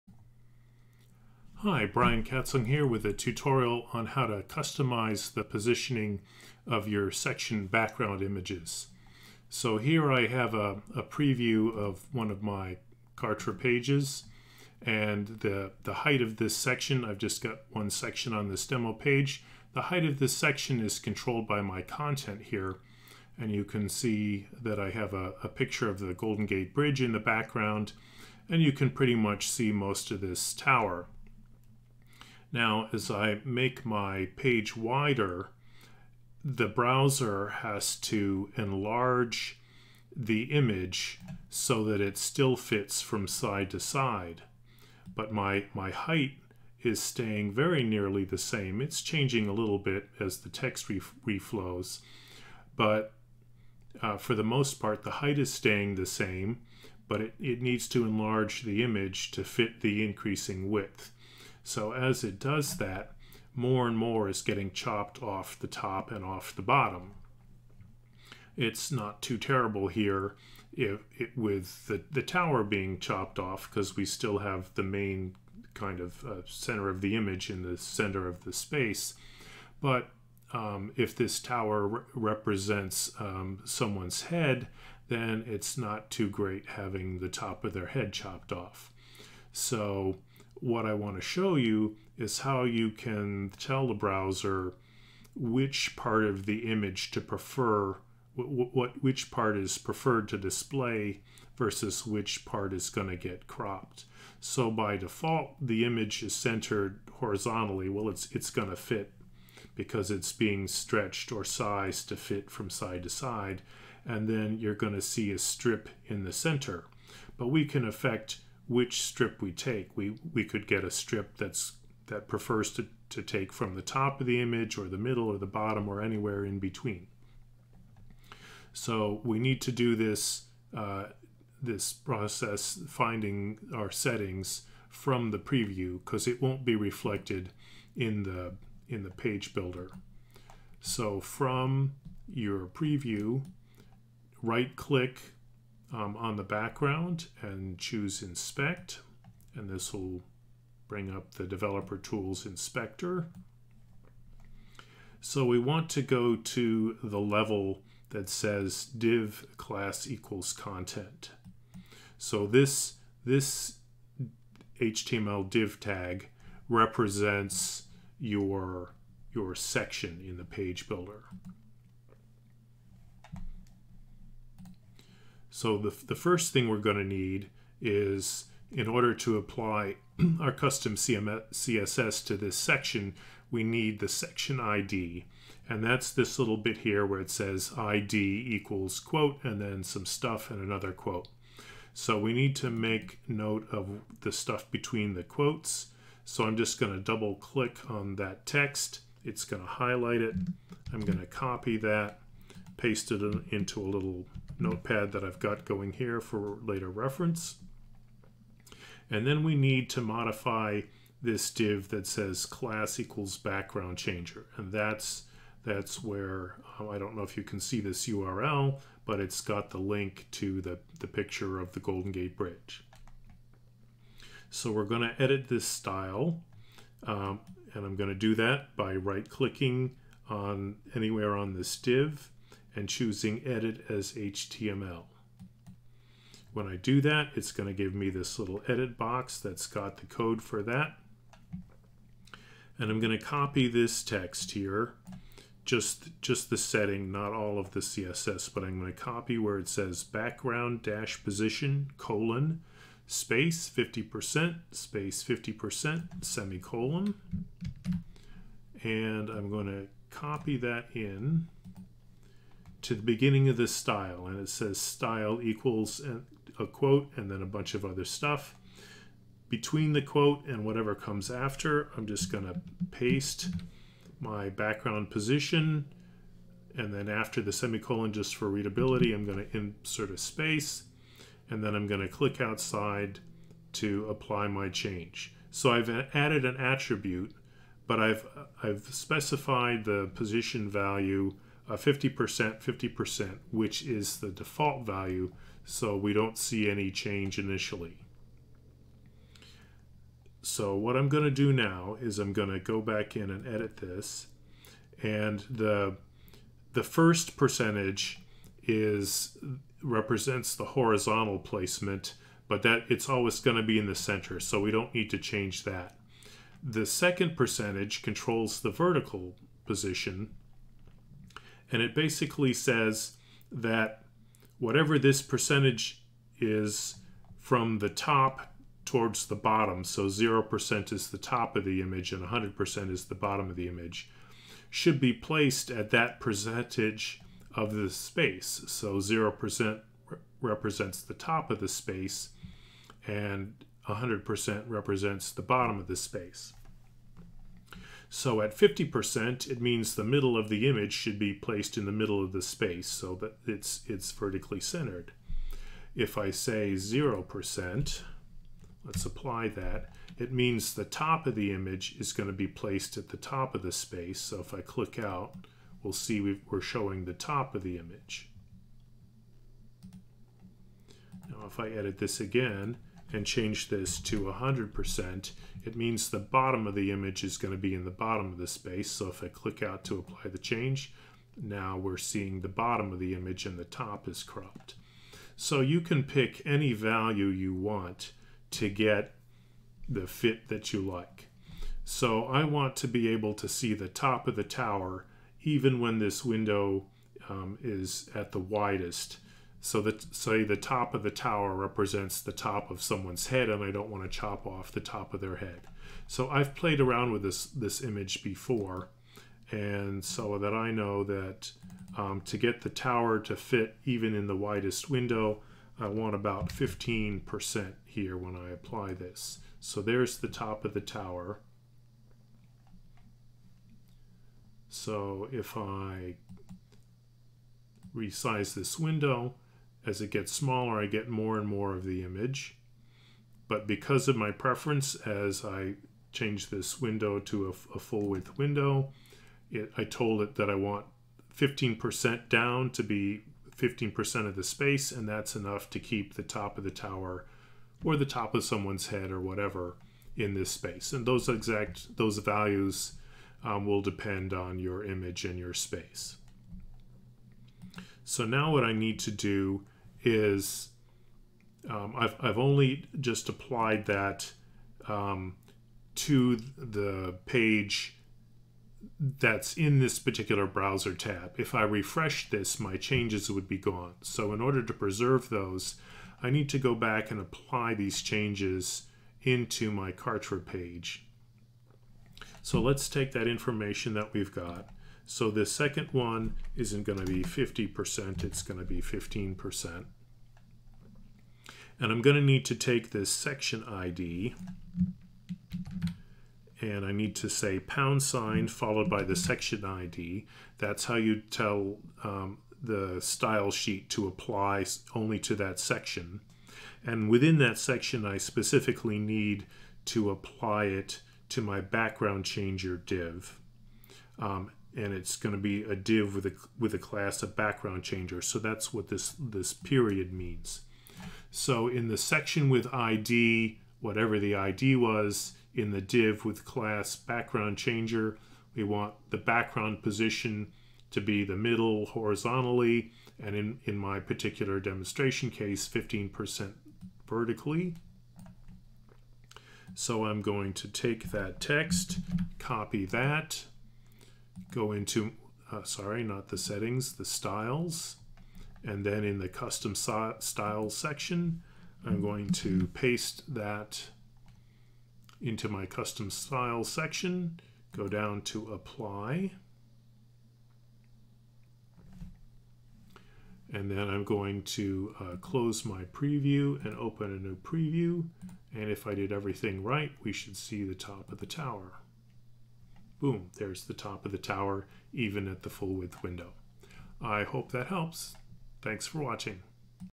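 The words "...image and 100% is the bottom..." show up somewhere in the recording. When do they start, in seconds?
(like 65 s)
331 s.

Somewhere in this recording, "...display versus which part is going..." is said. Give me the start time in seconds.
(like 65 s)
100 s.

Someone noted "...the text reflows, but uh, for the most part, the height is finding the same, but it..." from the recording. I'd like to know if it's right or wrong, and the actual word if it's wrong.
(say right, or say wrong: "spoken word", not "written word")
wrong: "staying", not "finding".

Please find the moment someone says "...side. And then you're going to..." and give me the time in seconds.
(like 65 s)
113 s.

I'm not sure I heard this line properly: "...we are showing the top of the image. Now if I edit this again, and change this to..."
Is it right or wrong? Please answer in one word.
right.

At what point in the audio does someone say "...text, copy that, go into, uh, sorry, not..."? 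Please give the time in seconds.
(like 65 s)
541 s.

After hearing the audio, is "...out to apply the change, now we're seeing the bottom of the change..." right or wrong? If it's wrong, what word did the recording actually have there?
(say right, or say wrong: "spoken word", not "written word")
wrong: "image", not "change".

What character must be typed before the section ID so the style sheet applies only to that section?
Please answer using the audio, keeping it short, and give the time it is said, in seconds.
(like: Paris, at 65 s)
pound sign, at 497 s.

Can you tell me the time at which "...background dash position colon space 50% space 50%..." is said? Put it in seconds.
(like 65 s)
250 s.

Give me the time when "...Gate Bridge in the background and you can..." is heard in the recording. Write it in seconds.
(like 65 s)
26 s.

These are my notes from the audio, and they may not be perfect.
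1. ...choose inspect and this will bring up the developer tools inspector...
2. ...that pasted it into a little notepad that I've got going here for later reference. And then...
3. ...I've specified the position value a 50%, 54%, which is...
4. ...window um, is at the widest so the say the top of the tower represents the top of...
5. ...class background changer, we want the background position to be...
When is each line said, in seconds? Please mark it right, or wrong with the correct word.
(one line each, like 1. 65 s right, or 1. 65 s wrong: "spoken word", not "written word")
1. 147 s right
2. 201 s right
3. 288 s wrong: "50", not "54"
4. 396 s right
5. 526 s right.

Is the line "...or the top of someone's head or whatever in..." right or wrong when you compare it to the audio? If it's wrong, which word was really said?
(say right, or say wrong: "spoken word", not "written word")
right.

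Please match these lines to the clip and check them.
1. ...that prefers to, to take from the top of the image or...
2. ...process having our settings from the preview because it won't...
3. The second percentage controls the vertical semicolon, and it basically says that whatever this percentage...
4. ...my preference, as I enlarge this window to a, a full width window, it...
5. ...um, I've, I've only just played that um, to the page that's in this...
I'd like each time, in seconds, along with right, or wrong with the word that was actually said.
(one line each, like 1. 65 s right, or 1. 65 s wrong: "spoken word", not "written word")
1. 122 s right
2. 131 s wrong: "finding", not "having"
3. 316 s wrong: "position", not "semicolon"
4. 434 s wrong: "change", not "enlarge"
5. 461 s wrong: "applied", not "played".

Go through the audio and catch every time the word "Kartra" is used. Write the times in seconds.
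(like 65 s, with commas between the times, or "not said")
13 s, 479 s.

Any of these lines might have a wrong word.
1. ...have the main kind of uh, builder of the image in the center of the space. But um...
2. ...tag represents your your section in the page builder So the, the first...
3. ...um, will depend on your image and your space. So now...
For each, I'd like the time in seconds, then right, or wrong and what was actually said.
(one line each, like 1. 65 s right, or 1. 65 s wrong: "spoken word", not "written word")
1. 74 s wrong: "center", not "builder"
2. 165 s right
3. 453 s right.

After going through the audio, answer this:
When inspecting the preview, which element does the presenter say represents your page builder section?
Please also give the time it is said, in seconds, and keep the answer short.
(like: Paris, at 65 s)
div class equals content, at 158 s.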